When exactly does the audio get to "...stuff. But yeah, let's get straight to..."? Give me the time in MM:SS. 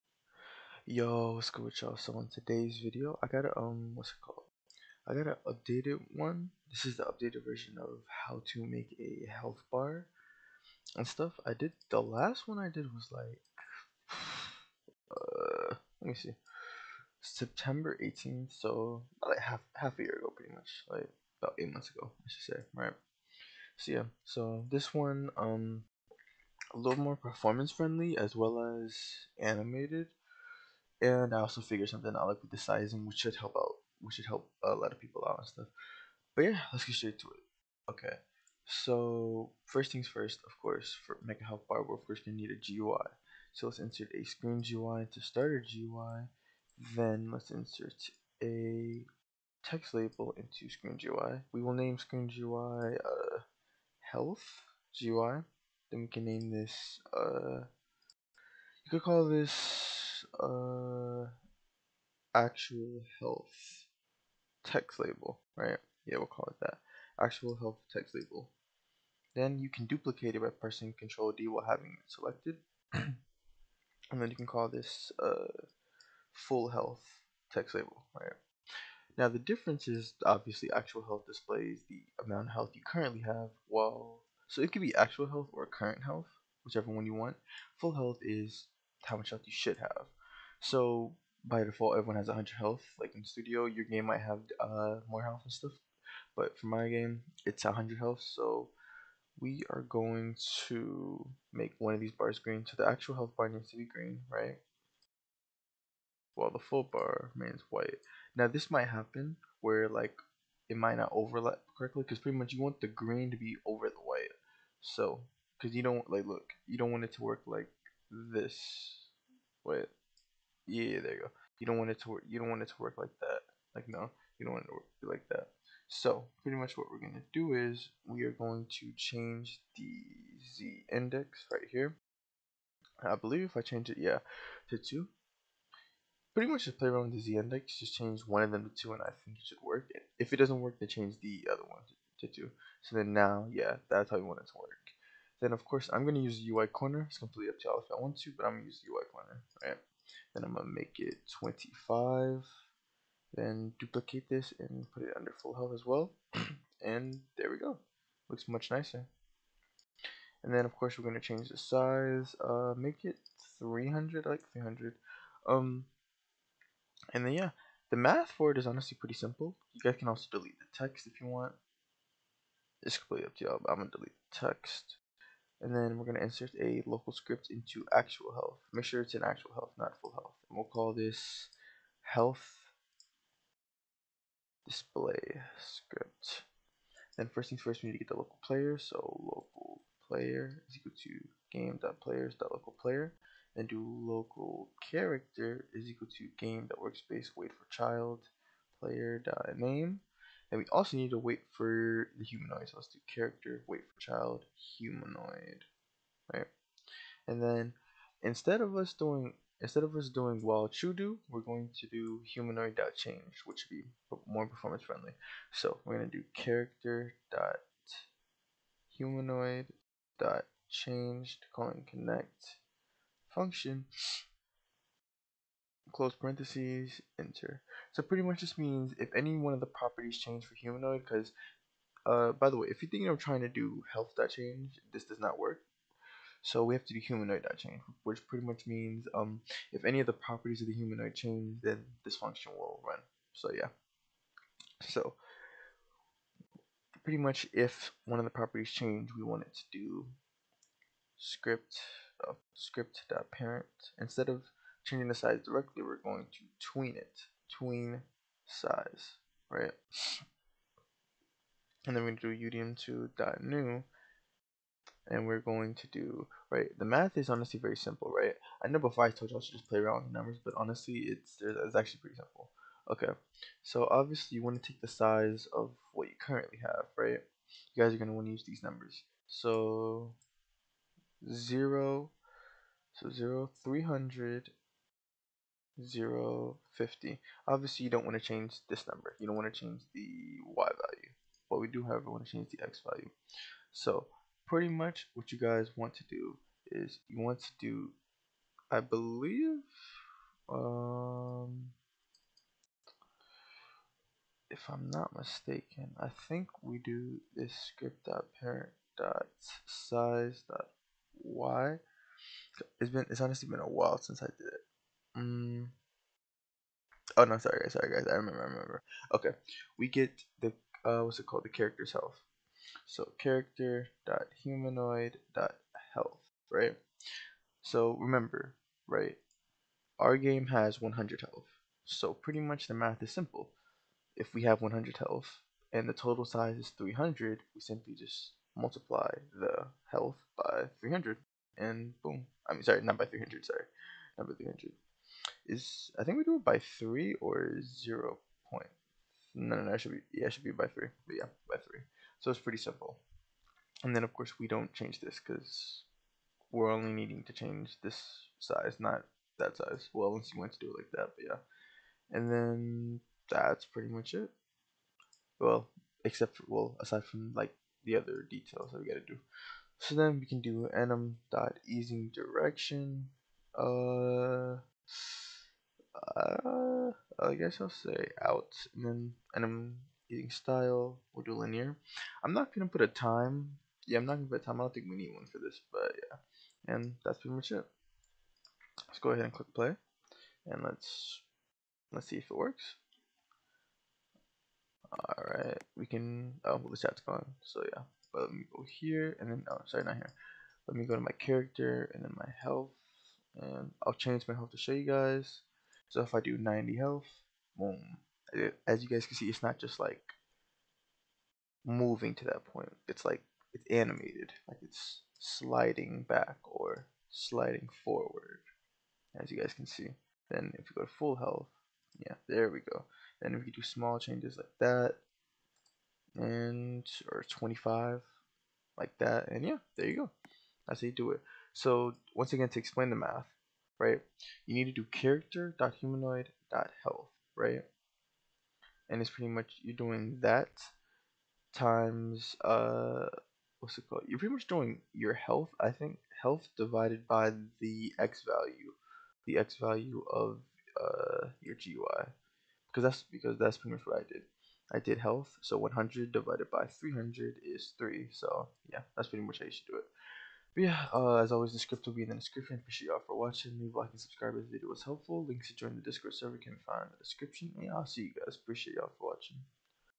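00:35.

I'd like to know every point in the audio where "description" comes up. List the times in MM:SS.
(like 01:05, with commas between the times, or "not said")
07:42, 07:47.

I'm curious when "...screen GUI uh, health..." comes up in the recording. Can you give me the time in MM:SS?
00:51.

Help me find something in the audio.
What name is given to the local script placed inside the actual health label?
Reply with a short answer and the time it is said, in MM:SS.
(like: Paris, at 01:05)
health display script, at 03:02.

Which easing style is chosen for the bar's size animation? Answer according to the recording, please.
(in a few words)
linear.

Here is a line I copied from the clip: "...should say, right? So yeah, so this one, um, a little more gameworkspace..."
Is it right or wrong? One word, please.
wrong.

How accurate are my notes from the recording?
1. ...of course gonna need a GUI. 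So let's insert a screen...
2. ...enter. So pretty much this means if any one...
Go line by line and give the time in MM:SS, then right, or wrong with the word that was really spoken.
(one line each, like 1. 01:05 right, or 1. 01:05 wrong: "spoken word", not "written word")
1. 00:41 right
2. 03:47 right.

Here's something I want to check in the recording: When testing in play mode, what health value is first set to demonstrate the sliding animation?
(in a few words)
90.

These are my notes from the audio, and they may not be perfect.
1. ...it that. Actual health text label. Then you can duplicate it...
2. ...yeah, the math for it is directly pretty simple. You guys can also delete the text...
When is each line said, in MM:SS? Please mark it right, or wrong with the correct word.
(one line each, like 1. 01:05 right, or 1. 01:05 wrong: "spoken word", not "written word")
1. 01:06 right
2. 02:47 wrong: "honestly", not "directly".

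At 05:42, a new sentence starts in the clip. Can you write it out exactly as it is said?
I mean, sorry, not by 300, sorry.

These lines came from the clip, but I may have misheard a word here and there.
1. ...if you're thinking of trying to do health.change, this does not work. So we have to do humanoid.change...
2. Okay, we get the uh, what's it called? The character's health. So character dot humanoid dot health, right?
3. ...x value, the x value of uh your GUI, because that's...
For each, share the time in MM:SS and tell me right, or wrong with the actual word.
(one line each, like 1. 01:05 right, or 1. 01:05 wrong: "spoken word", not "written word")
1. 03:52 right
2. 05:19 right
3. 07:27 right.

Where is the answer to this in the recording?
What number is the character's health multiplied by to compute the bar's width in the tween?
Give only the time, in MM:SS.
05:50.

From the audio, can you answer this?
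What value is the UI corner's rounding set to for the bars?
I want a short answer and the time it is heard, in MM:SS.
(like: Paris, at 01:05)
25, at 02:30.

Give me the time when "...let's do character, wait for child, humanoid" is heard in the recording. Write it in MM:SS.
03:22.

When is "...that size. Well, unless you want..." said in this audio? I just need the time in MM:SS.
05:59.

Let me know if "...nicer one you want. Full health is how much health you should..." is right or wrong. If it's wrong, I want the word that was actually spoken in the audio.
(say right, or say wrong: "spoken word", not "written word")
wrong: "whichever", not "nicer".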